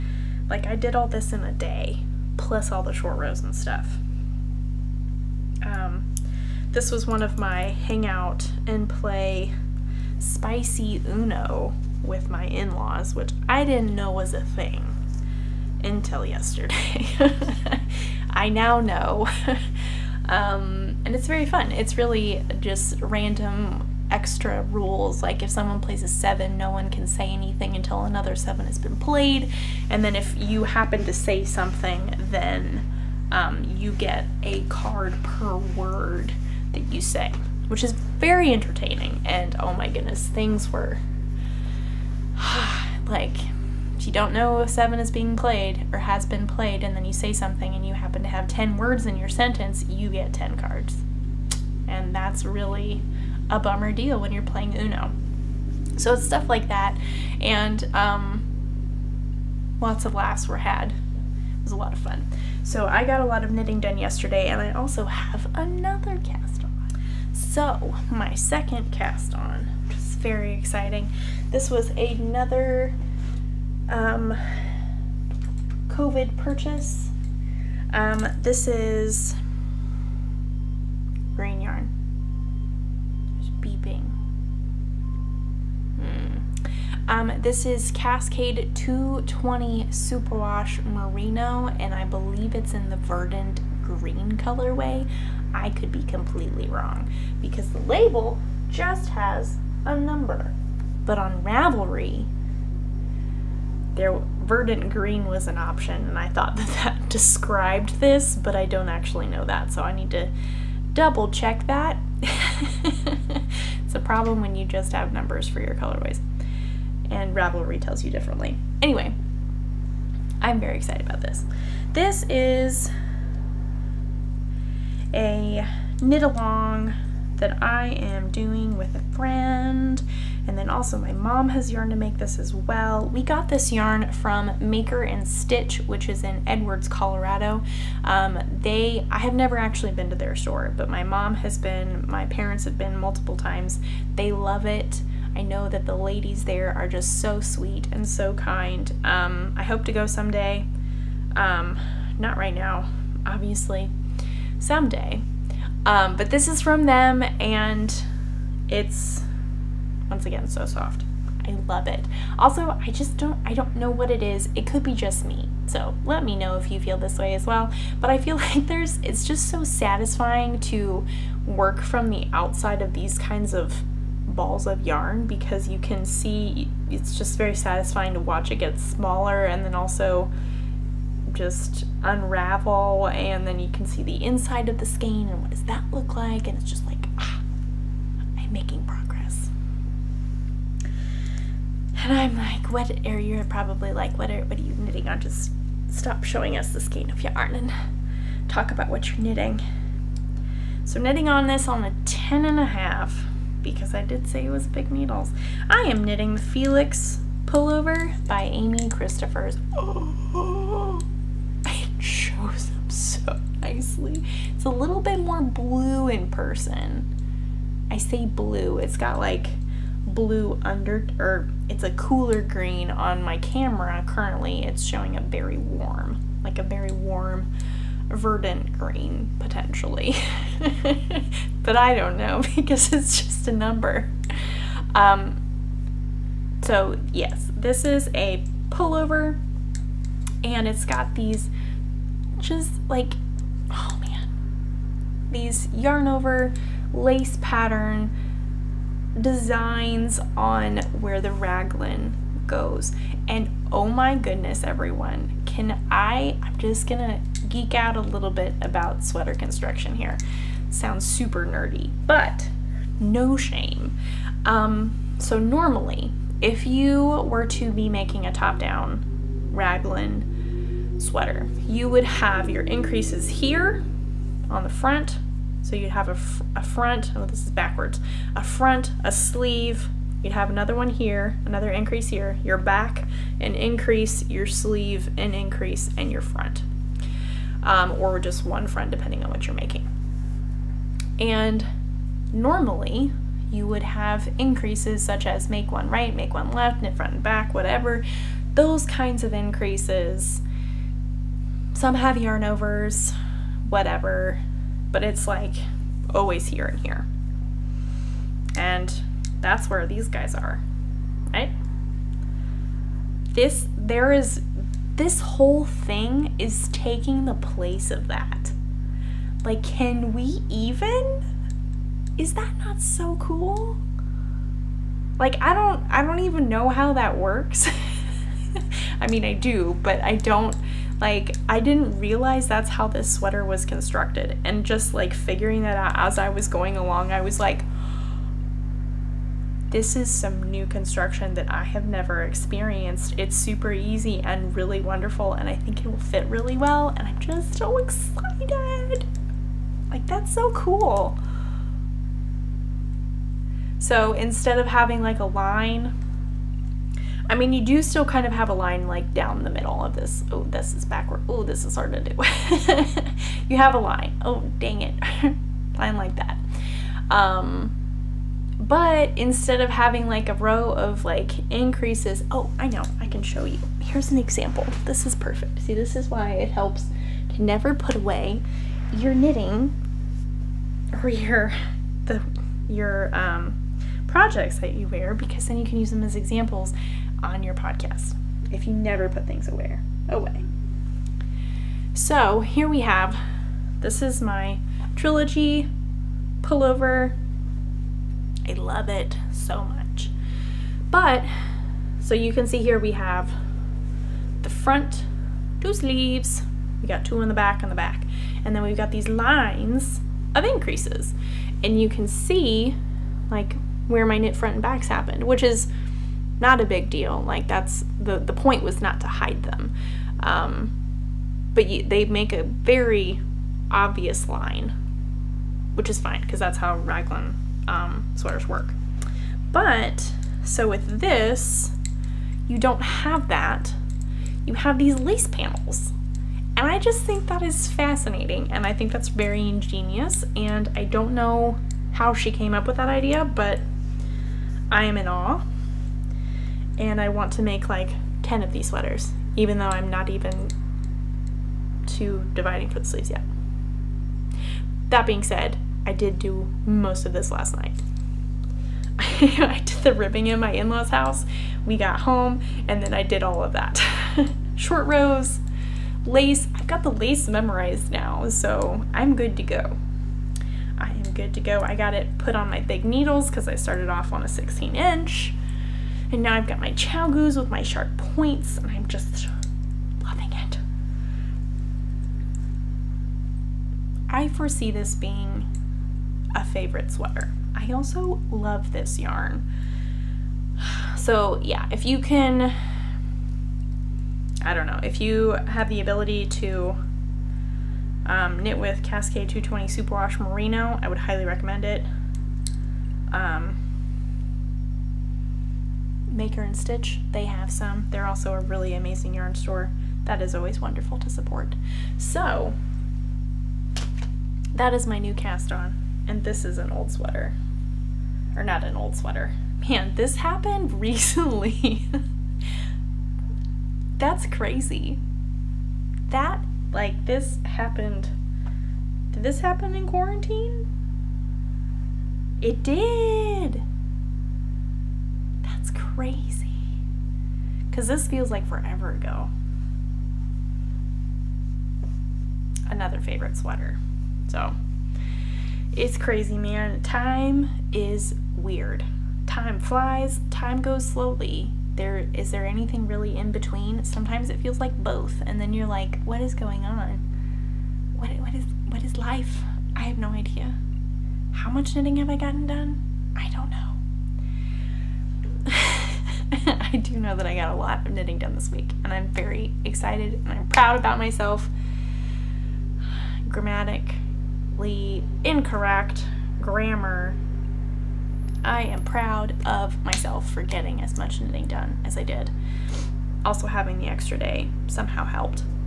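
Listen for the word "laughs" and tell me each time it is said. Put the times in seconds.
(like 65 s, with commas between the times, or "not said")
60 s.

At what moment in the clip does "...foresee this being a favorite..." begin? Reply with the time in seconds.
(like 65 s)
484 s.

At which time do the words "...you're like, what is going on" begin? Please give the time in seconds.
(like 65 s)
555 s.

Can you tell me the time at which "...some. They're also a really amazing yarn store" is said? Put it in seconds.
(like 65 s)
507 s.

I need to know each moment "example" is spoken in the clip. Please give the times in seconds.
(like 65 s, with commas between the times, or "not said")
374 s, 386 s.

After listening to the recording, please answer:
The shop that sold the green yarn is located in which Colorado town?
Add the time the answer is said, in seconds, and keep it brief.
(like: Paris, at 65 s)
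Edwards, at 136 s.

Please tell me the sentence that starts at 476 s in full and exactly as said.
And now I've got my ChiaoGoos with my sharp points and I'm just loving it.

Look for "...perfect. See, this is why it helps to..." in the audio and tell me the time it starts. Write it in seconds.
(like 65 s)
375 s.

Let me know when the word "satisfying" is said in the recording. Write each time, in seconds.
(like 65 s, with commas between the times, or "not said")
169 s, 177 s.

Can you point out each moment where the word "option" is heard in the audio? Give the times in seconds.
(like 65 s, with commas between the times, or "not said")
105 s.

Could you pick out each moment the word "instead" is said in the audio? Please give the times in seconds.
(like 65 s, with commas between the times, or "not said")
354 s, 369 s.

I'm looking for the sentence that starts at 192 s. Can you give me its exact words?
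And I'm like, what are you probably like, what are, what are you knitting on?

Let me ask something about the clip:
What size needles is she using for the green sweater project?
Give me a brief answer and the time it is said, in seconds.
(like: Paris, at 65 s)
10.5, at 202 s.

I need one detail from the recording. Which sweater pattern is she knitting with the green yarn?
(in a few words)
Felix pullover.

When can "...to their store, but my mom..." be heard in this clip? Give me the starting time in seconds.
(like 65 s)
140 s.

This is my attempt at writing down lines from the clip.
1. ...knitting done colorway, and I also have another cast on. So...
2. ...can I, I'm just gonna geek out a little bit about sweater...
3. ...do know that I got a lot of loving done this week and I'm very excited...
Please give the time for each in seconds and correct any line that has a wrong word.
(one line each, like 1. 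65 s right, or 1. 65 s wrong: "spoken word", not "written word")
1. 63 s wrong: "yesterday", not "colorway"
2. 255 s right
3. 566 s wrong: "knitting", not "loving".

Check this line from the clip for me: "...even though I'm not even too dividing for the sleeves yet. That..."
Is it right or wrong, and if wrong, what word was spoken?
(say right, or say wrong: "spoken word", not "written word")
right.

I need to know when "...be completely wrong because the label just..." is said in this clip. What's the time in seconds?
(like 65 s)
95 s.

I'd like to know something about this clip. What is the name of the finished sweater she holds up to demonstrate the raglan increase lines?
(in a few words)
Trilogy pullover.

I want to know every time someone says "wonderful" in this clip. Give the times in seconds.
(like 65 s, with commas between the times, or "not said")
344 s, 510 s.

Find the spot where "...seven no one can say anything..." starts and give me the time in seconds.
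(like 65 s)
26 s.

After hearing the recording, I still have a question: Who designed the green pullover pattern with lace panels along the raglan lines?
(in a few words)
Amy Christoffers.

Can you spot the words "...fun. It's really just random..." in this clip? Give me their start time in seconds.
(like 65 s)
21 s.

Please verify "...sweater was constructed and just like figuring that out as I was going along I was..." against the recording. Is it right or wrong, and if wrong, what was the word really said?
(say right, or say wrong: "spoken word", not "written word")
right.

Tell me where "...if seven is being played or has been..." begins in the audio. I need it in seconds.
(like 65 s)
44 s.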